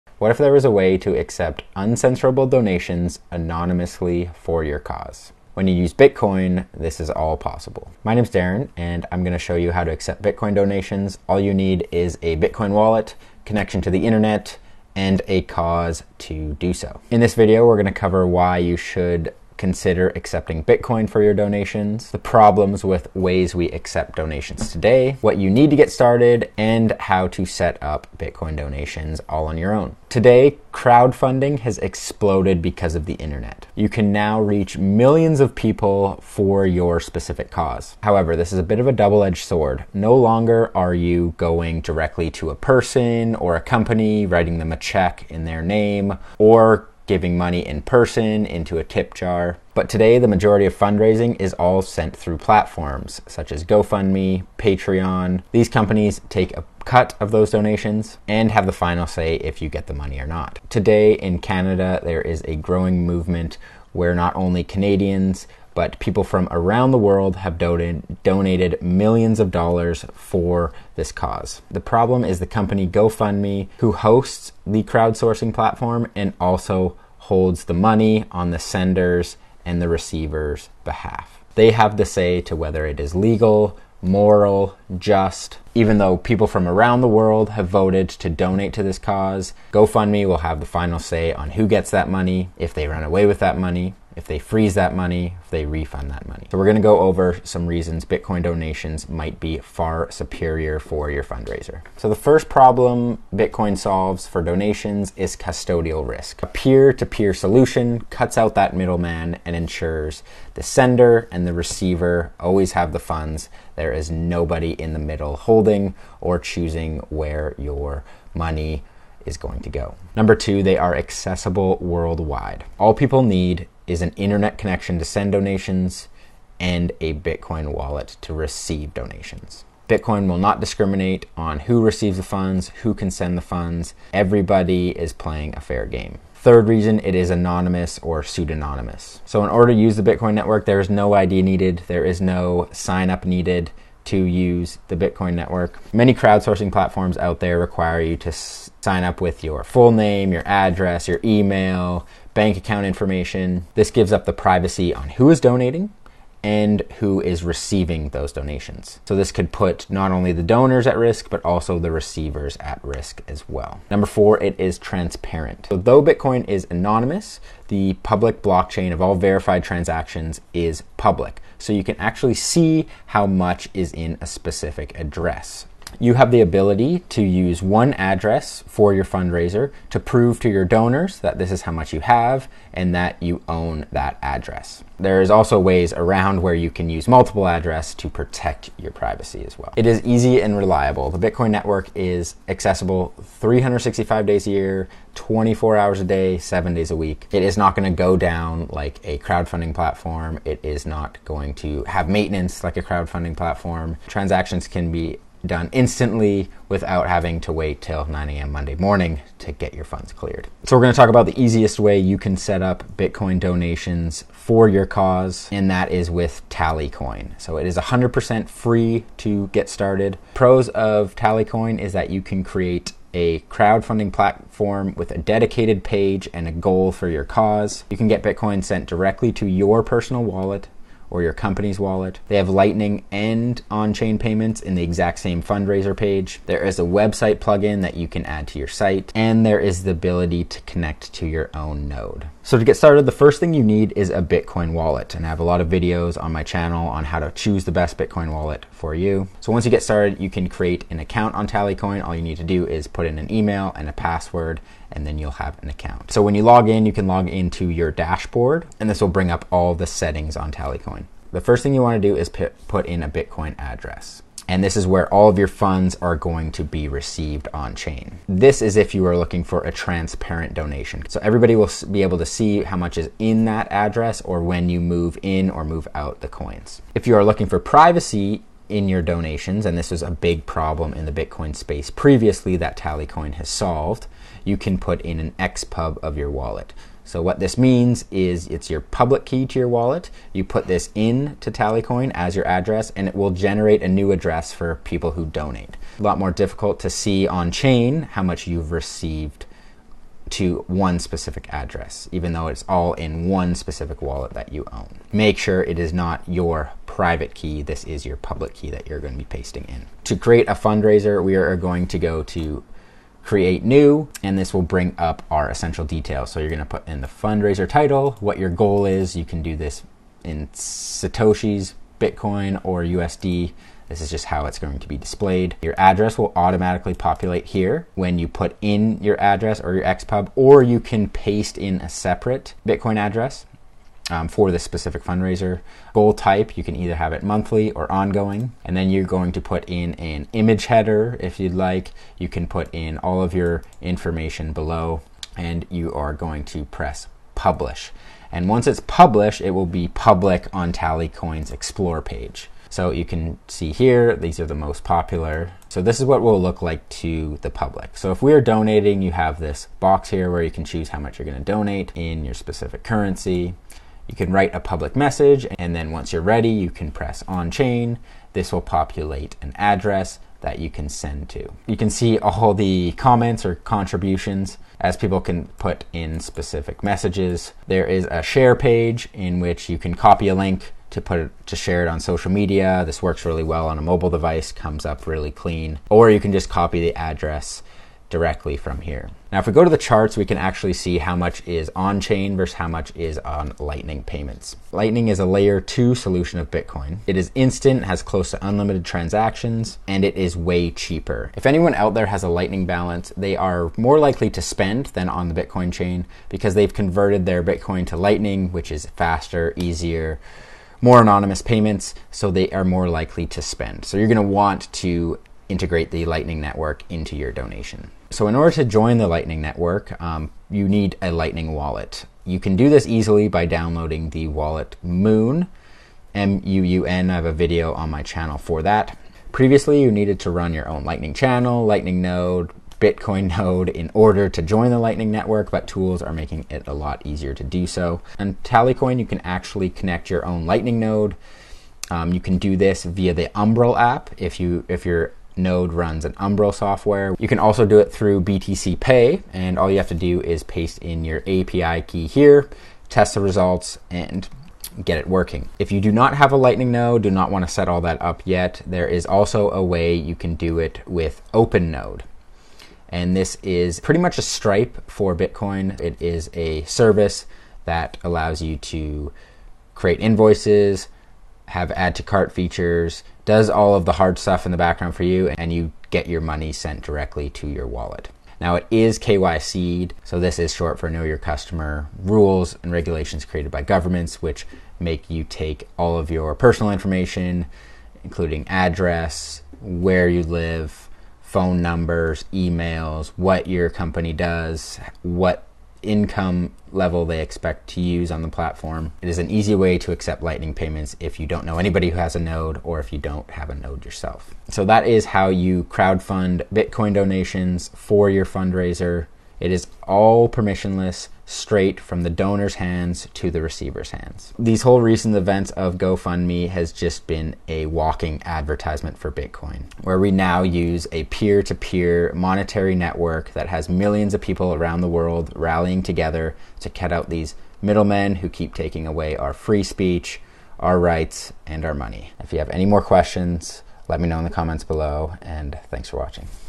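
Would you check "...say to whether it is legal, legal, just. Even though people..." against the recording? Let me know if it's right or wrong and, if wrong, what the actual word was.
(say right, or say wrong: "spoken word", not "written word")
wrong: "moral", not "legal".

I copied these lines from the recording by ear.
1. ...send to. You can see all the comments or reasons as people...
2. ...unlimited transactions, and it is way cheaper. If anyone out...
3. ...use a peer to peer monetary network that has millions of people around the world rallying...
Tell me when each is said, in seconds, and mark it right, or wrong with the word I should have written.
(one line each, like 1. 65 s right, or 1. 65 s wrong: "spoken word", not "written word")
1. 370 s wrong: "contributions", not "reasons"
2. 398 s right
3. 520 s right.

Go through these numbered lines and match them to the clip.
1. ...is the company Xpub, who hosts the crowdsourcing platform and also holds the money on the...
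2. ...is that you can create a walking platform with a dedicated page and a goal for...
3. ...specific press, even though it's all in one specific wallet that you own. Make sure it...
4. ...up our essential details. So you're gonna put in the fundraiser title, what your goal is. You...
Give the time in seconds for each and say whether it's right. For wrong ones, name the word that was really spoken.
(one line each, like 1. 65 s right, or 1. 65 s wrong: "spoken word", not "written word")
1. 72 s wrong: "GoFundMe", not "Xpub"
2. 221 s wrong: "crowdfunding", not "walking"
3. 300 s wrong: "address", not "press"
4. 314 s right.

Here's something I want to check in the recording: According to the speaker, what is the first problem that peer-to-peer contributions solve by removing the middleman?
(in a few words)
Custodial risk.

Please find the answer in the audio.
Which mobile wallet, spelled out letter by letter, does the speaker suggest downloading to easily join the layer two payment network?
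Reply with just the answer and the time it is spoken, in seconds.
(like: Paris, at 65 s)
Muun, at 424 s.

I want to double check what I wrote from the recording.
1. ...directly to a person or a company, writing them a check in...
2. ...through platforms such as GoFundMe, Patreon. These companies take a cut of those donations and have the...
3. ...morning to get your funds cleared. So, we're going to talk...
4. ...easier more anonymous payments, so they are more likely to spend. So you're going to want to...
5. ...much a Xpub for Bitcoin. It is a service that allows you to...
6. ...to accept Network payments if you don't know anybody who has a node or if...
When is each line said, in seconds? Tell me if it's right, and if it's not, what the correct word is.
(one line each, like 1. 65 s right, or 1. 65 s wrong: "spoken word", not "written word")
1. 41 s right
2. 52 s right
3. 208 s right
4. 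409 s right
5. 464 s wrong: "Stripe", not "Xpub"
6. 499 s wrong: "Lightning", not "Network".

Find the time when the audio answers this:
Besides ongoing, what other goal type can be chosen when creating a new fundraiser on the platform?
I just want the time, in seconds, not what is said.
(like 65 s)
337 s.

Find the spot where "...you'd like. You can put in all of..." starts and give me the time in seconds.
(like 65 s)
341 s.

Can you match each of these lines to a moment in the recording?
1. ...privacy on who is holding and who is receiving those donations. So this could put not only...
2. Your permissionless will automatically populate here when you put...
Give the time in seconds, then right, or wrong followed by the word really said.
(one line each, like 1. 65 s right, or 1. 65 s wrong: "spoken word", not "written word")
1. 154 s wrong: "donating", not "holding"
2. 325 s wrong: "address", not "permissionless".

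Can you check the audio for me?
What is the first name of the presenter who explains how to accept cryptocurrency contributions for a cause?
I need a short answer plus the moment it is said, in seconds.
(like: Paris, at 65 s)
Darren, at 8 s.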